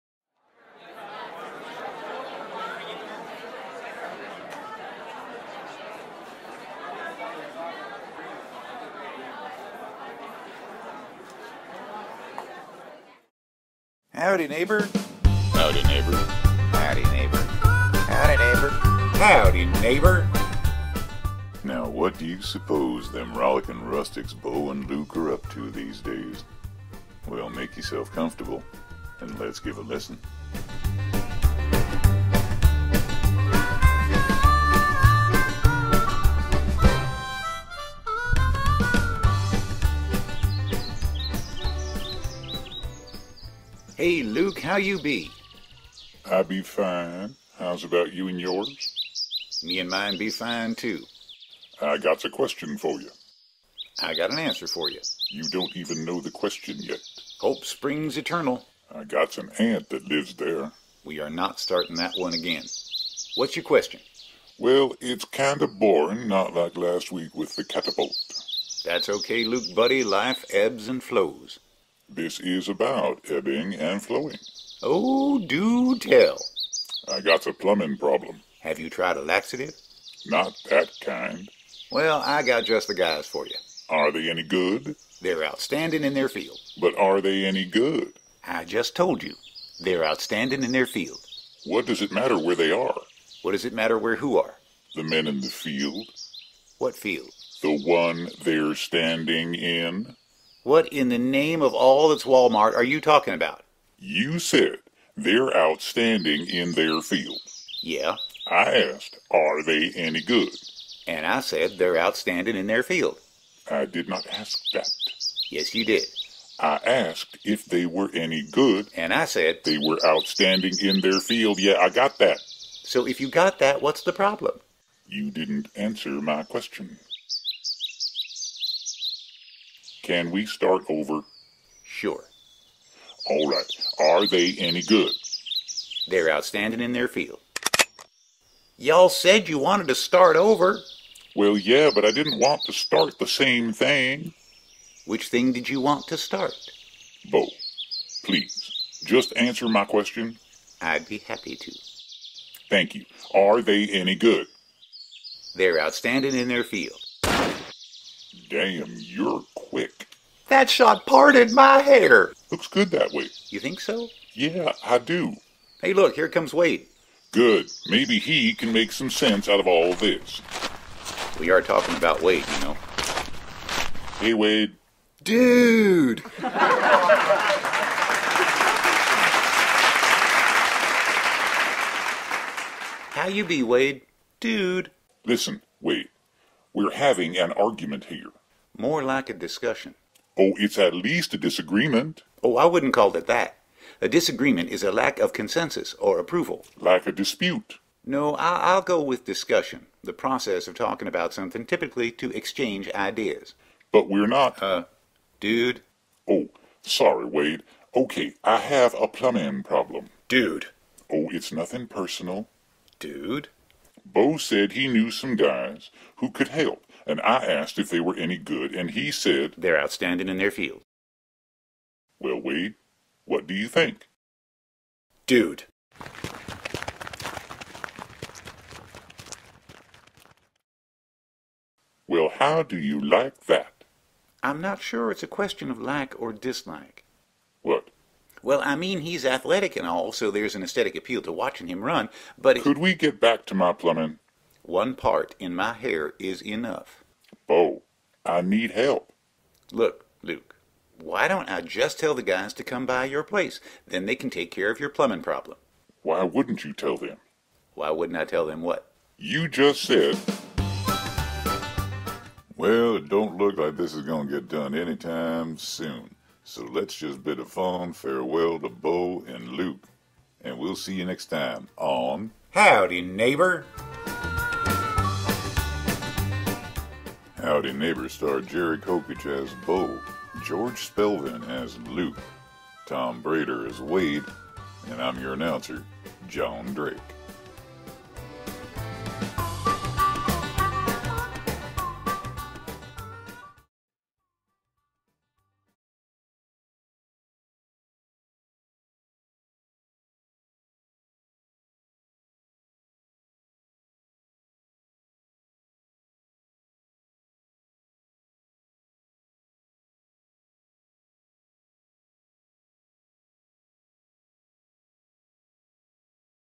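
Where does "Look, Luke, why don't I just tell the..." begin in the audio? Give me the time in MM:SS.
04:09.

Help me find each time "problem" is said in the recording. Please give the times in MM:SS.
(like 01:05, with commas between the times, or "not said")
01:17, 02:04, 03:29, 04:15.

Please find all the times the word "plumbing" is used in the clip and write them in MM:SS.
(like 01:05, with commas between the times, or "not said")
01:17, 03:29, 04:03, 04:14.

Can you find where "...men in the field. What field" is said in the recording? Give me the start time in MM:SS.
01:35.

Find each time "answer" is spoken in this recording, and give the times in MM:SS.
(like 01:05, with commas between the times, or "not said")
00:54, 02:05, 02:29.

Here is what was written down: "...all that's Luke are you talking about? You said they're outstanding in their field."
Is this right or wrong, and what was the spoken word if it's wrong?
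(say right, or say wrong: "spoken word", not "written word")
wrong: "Walmart", not "Luke".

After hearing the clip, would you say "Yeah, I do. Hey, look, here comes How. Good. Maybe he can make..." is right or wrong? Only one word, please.
wrong.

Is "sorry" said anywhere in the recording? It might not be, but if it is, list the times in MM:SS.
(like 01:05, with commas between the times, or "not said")
03:26.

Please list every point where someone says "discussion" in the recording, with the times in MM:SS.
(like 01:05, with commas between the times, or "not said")
03:09, 03:19.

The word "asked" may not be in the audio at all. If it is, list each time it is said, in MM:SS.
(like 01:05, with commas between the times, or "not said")
01:48, 01:56, 03:37.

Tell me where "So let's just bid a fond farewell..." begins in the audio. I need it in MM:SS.
04:26.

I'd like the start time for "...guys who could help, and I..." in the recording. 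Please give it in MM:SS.
03:35.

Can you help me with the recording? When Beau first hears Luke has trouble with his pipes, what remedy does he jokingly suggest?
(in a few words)
a laxative.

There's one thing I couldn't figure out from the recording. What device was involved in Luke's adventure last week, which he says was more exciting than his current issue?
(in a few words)
catapult.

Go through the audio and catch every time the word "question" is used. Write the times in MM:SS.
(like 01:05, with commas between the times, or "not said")
00:52, 00:56, 01:03, 02:06, 02:29, 03:55.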